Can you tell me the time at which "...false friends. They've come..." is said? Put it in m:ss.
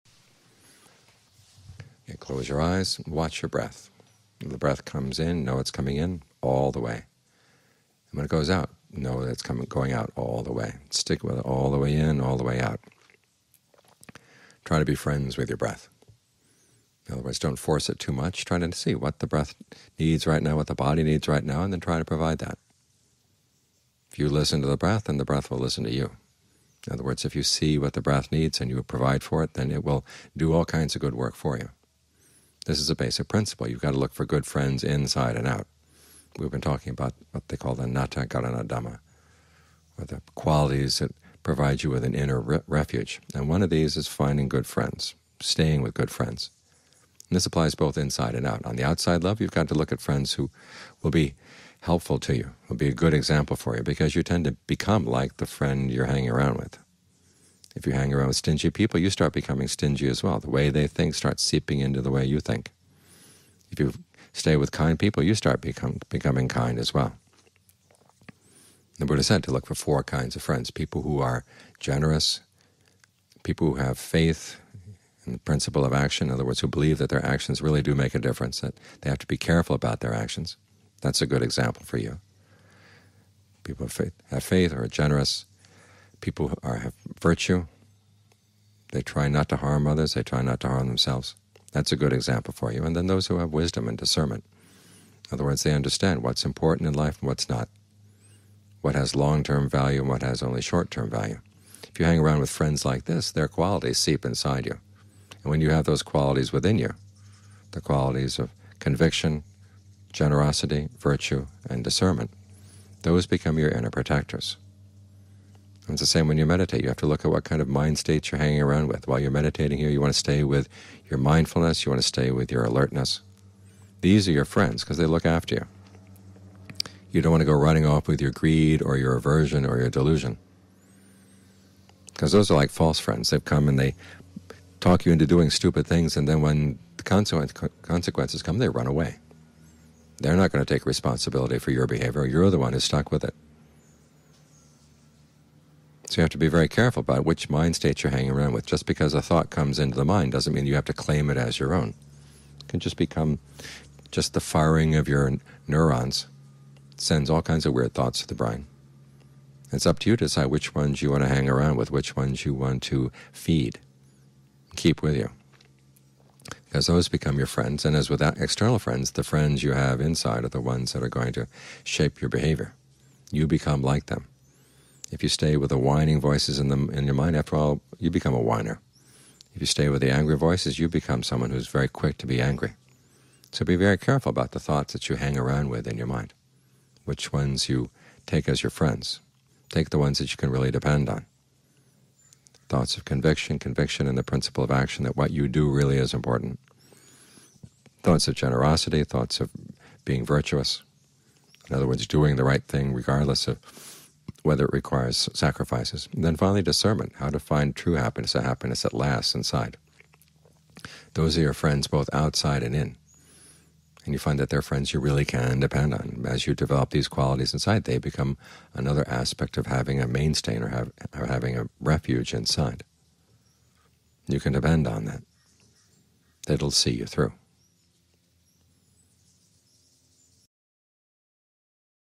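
2:12.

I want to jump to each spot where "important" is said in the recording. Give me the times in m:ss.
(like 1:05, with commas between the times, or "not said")
1:36, 3:16.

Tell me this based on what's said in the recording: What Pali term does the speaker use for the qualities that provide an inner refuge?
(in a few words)
nathakarana dhamma.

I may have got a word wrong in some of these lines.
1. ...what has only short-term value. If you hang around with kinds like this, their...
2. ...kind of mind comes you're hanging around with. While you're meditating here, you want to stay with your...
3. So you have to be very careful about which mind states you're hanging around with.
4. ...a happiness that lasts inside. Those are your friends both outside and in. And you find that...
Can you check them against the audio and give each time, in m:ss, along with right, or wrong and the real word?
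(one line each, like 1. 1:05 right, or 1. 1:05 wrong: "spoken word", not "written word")
1. 1:40 wrong: "friends", not "kinds"
2. 1:57 wrong: "states", not "comes"
3. 2:26 right
4. 3:28 right.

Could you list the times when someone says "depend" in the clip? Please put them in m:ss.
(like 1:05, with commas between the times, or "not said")
3:10, 3:35, 3:44.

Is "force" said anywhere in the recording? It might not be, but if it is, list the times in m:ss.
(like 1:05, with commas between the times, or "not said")
0:17.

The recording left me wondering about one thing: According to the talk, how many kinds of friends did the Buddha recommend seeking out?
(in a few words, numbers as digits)
4.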